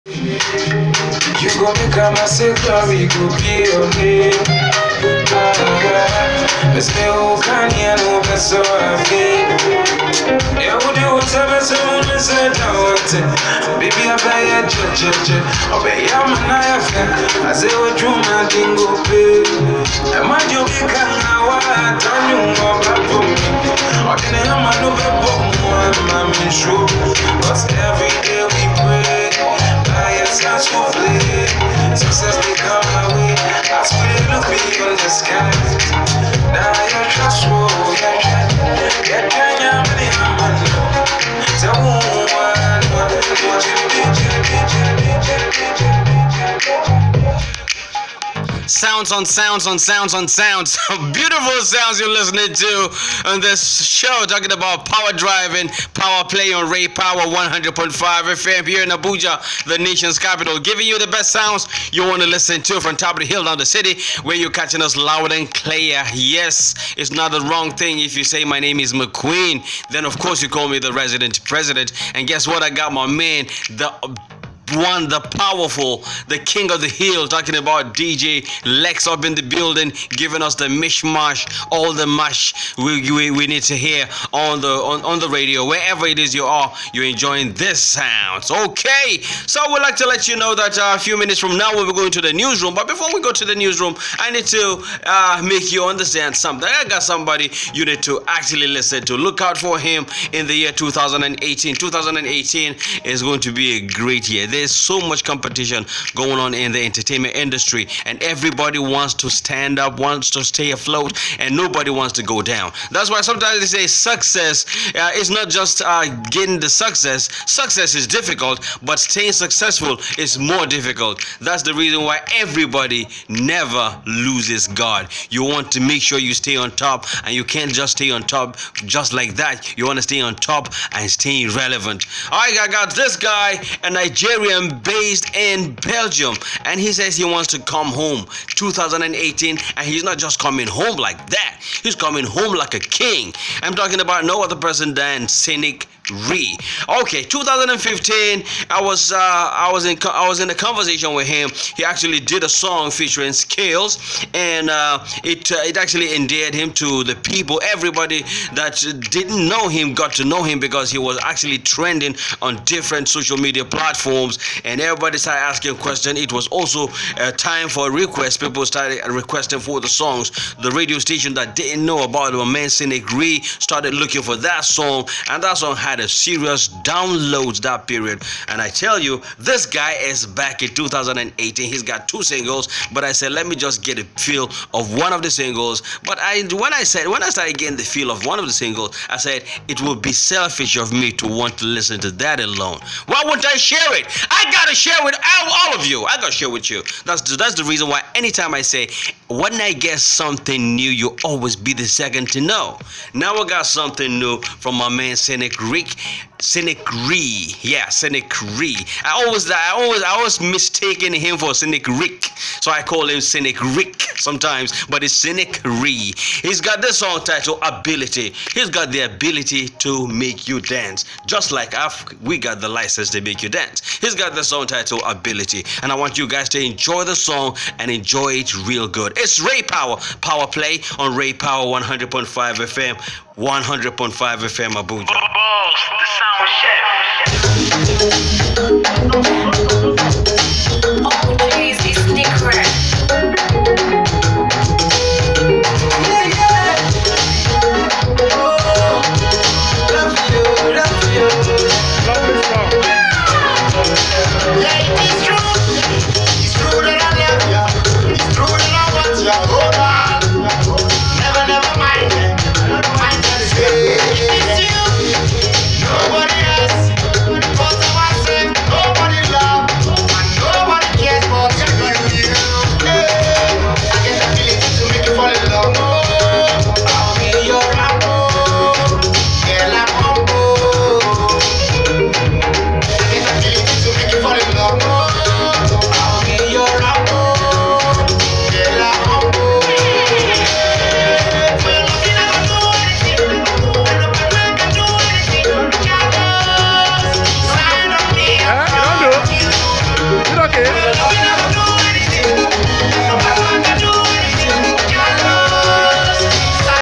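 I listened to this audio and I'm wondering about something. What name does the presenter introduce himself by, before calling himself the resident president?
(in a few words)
Maquin.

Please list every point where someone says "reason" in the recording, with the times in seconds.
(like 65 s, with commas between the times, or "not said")
121 s, 197 s.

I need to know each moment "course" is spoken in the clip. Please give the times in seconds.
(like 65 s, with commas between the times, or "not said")
70 s.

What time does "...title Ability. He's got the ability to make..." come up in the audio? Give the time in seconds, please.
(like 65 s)
217 s.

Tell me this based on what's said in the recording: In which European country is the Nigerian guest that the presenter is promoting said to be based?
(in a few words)
Belgium.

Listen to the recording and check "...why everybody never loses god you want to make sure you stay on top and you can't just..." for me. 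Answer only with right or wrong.
right.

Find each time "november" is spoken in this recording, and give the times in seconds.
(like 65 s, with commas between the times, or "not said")
not said.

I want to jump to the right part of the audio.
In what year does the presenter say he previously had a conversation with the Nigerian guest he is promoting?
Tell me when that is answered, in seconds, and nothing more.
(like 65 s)
147 s.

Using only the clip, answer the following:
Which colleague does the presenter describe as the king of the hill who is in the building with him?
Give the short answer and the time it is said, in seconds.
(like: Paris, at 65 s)
DJ Lex, at 77 s.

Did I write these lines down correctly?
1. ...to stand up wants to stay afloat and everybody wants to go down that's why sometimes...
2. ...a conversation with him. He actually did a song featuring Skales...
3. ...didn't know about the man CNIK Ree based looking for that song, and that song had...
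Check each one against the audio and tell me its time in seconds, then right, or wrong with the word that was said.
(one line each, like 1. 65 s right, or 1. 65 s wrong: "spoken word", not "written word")
1. 109 s wrong: "nobody", not "everybody"
2. 150 s right
3. 171 s wrong: "started", not "based".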